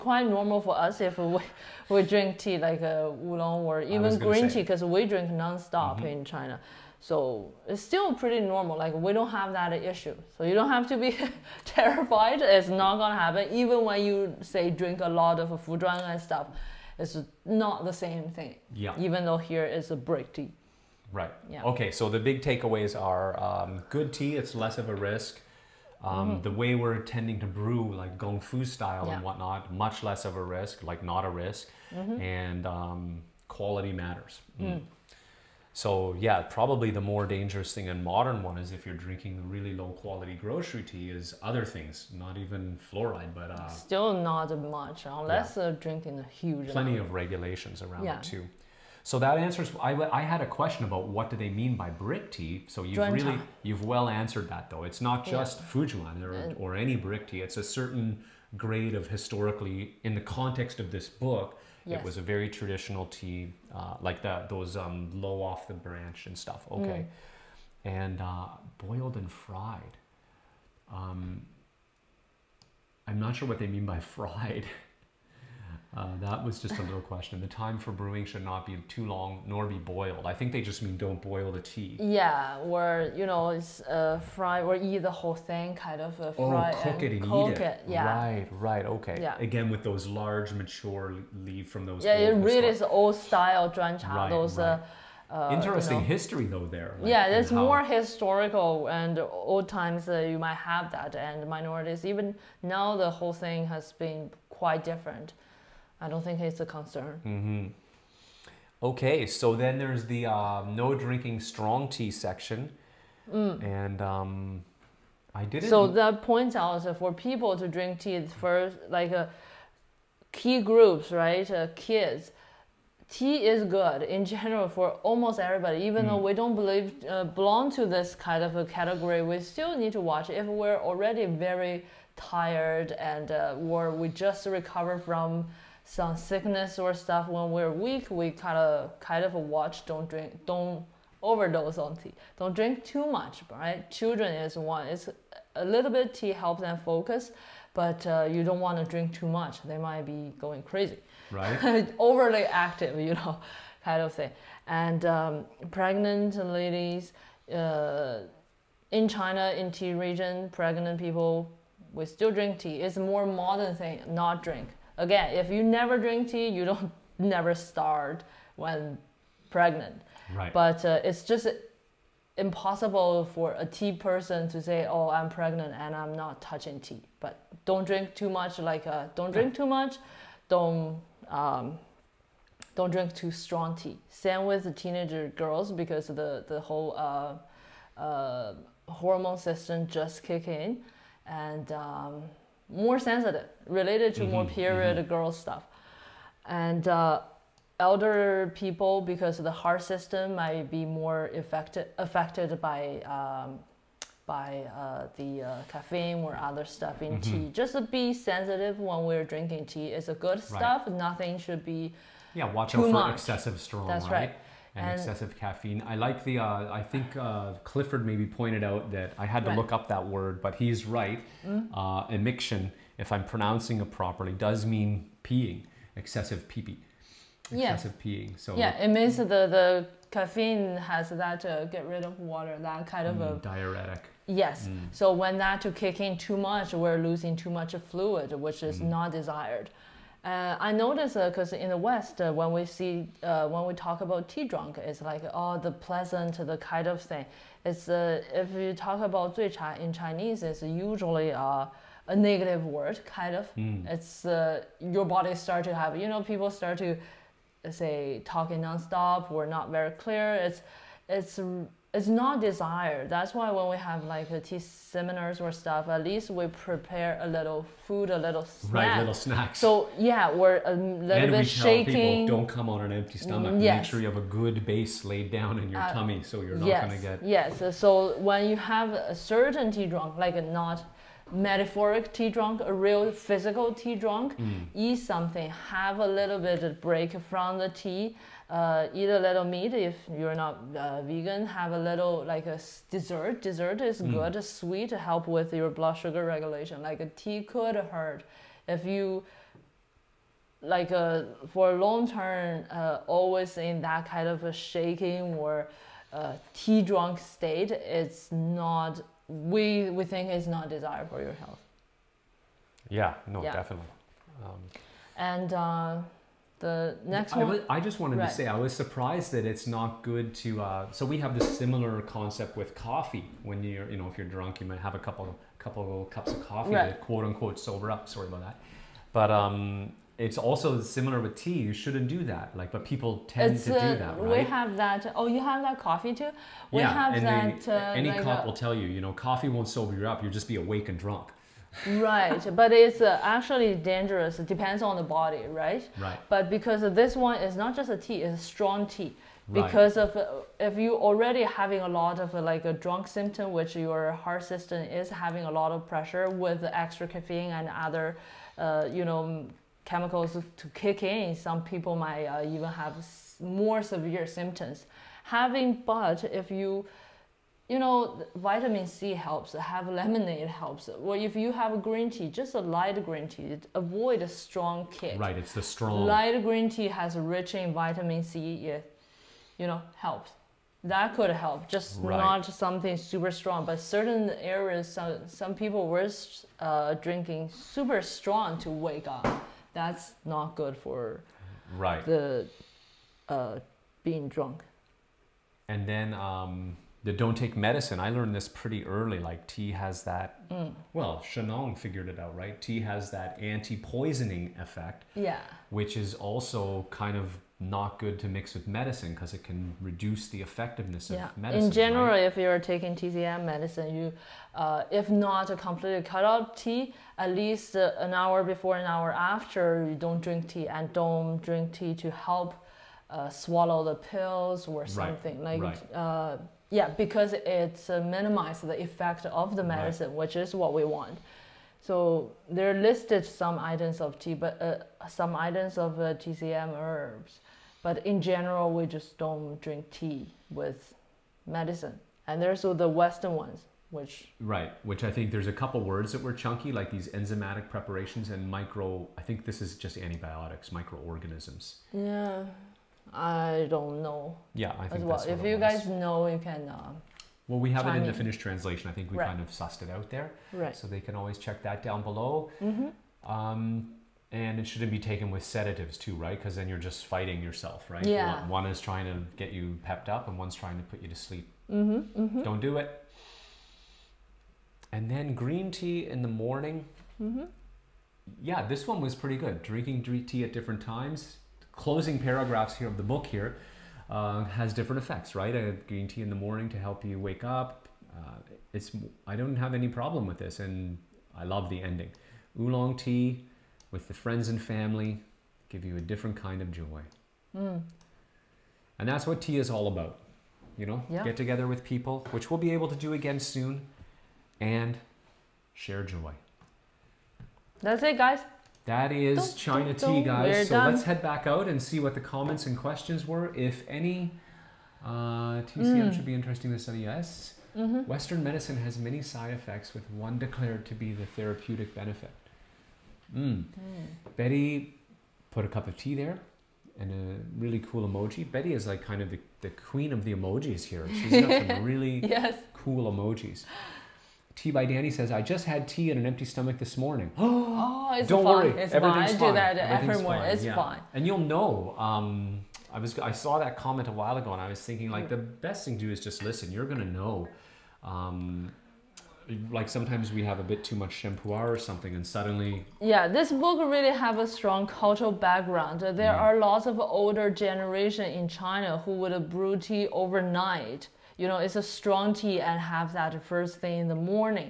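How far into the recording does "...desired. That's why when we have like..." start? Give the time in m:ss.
4:22.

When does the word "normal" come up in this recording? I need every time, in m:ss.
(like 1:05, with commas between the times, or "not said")
0:00, 0:08.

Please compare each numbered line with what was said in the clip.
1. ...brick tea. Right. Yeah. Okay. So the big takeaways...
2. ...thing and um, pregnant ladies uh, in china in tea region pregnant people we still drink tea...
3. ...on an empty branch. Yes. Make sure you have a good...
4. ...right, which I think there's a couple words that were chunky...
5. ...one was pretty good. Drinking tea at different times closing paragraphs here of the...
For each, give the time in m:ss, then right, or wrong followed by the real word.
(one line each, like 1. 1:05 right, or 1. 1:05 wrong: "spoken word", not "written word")
1. 0:19 right
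2. 2:34 right
3. 4:32 wrong: "stomach", not "branch"
4. 7:24 right
5. 7:58 right.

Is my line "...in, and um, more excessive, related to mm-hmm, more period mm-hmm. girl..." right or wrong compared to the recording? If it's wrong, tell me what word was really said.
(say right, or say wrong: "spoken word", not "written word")
wrong: "sensitive", not "excessive".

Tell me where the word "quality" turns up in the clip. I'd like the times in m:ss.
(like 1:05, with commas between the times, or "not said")
0:33, 0:39.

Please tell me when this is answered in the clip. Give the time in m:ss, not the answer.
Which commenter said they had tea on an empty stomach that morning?
8:54.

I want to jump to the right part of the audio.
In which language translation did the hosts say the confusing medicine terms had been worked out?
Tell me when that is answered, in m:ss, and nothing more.
7:38.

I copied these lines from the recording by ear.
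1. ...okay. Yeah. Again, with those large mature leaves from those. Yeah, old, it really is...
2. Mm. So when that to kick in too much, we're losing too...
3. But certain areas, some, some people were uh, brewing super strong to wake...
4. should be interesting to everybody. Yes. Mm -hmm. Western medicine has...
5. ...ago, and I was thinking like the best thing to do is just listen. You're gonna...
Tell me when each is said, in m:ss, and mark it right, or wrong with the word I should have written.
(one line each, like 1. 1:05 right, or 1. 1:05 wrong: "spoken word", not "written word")
1. 1:28 right
2. 3:54 right
3. 6:23 wrong: "drinking", not "brewing"
4. 8:36 wrong: "study", not "everybody"
5. 9:04 right.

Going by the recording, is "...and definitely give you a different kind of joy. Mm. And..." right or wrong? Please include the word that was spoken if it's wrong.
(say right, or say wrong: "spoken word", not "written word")
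wrong: "family", not "definitely".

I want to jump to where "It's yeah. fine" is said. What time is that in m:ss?
9:00.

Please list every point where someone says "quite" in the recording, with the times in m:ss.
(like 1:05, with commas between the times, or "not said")
1:44.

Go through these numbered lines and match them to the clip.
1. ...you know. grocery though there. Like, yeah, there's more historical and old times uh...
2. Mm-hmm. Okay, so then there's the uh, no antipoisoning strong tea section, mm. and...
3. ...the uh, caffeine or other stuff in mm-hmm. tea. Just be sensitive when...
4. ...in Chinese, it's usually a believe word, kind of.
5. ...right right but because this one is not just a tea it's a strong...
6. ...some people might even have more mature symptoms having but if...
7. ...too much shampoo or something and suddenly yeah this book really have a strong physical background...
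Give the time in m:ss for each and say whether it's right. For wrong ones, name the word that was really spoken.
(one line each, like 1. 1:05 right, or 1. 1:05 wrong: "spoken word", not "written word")
1. 1:35 wrong: "history", not "grocery"
2. 1:47 wrong: "drinking", not "antipoisoning"
3. 3:25 right
4. 4:09 wrong: "negative", not "believe"
5. 5:45 right
6. 6:01 wrong: "severe", not "mature"
7. 9:10 wrong: "cultural", not "physical".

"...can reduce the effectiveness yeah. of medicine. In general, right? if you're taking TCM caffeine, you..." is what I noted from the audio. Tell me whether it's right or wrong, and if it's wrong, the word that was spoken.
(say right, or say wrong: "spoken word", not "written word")
wrong: "medicine", not "caffeine".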